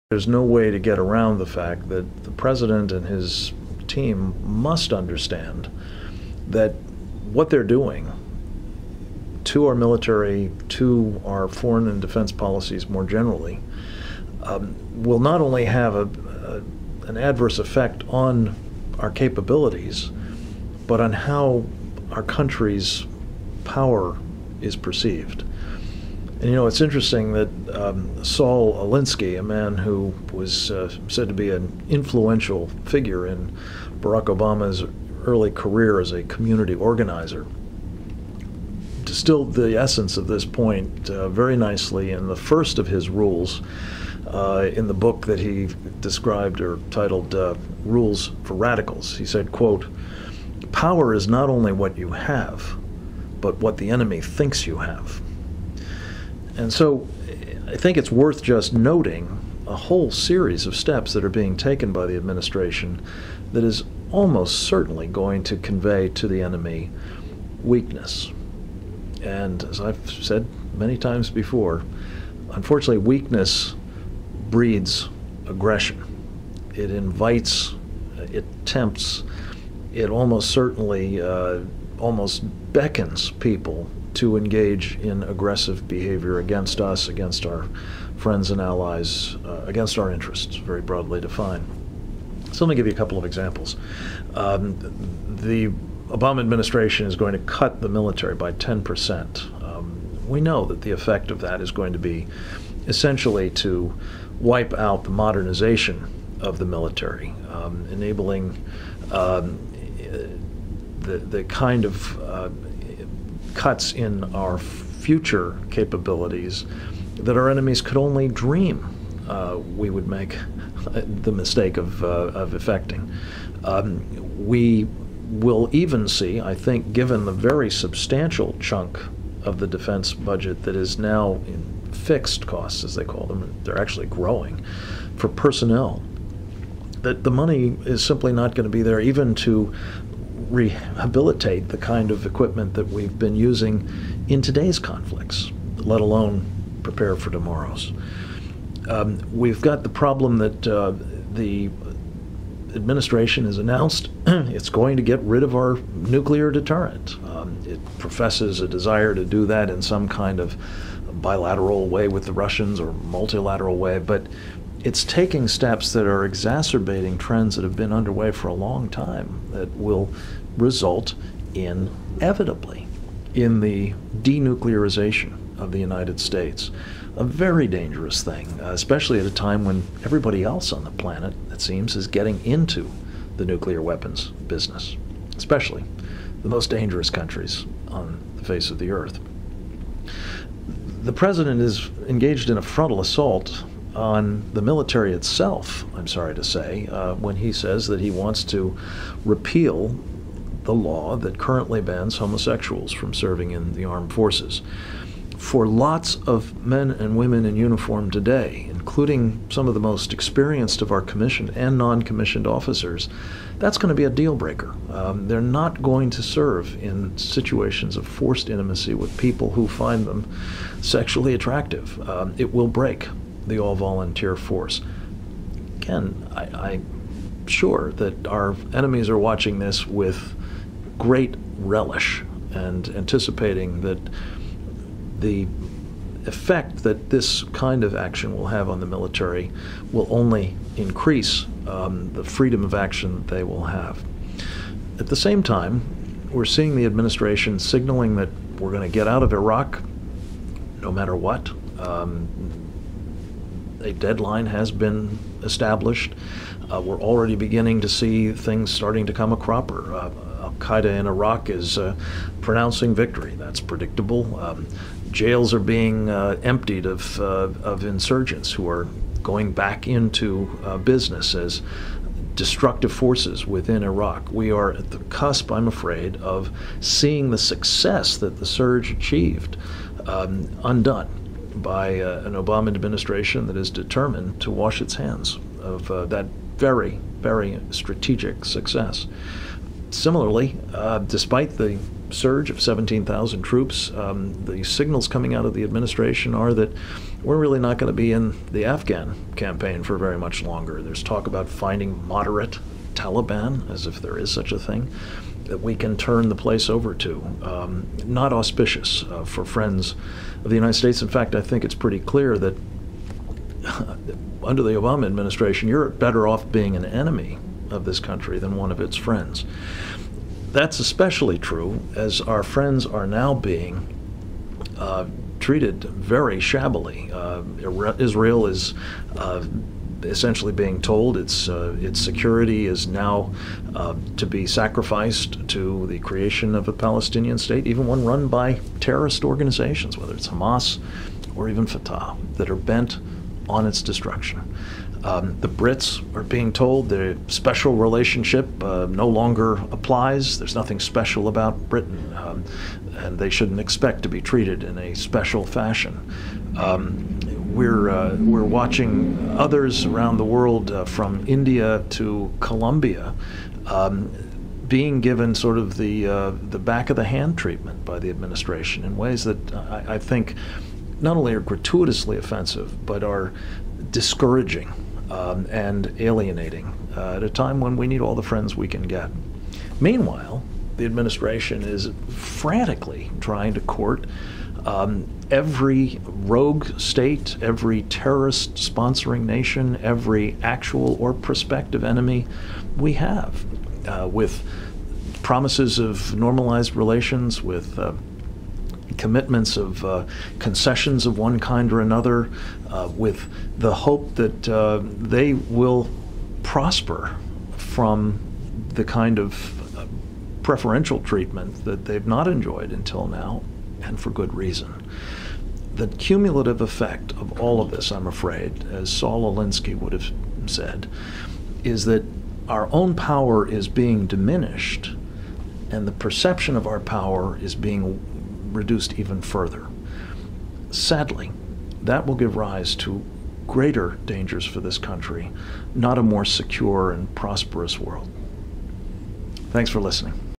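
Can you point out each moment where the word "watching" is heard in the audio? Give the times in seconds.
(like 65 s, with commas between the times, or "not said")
229 s, 358 s.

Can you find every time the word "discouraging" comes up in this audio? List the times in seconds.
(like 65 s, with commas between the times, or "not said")
373 s.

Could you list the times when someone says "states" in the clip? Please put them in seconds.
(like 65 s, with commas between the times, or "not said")
176 s, 310 s, 337 s, 386 s.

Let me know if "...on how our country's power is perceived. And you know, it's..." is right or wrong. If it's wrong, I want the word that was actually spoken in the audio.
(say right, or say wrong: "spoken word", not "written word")
right.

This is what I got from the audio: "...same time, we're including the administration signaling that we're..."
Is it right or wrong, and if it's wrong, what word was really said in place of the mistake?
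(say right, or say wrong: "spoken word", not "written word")
wrong: "seeing", not "including".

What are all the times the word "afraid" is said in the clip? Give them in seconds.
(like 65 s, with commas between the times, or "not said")
275 s, 418 s.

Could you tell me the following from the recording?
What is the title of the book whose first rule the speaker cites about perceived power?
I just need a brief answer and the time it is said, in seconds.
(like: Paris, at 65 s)
Rules for Radicals, at 47 s.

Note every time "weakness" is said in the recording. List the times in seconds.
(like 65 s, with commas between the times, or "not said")
67 s, 72 s.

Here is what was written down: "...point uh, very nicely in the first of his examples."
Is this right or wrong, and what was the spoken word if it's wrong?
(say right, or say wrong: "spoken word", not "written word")
wrong: "rules", not "examples".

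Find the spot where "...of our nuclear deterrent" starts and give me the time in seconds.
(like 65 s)
155 s.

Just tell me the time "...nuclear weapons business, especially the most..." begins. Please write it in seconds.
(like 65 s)
183 s.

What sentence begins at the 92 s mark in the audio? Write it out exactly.
So let me give you a couple of examples.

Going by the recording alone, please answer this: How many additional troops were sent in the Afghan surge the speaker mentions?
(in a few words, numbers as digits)
17,000.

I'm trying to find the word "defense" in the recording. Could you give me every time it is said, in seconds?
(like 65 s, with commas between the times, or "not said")
12 s, 129 s.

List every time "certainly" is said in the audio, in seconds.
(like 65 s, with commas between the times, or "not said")
64 s, 80 s.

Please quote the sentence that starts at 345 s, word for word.
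Um, the Brits are being told the special relationship uh, no longer applies.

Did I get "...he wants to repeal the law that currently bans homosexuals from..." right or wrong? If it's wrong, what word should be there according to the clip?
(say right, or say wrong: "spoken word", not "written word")
right.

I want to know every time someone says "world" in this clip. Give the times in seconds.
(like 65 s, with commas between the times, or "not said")
360 s, 437 s.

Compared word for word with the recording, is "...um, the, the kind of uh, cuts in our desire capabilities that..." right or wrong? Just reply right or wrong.
wrong.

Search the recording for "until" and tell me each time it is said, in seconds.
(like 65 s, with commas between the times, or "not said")
412 s.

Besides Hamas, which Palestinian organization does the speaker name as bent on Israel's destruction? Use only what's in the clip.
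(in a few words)
Fatah.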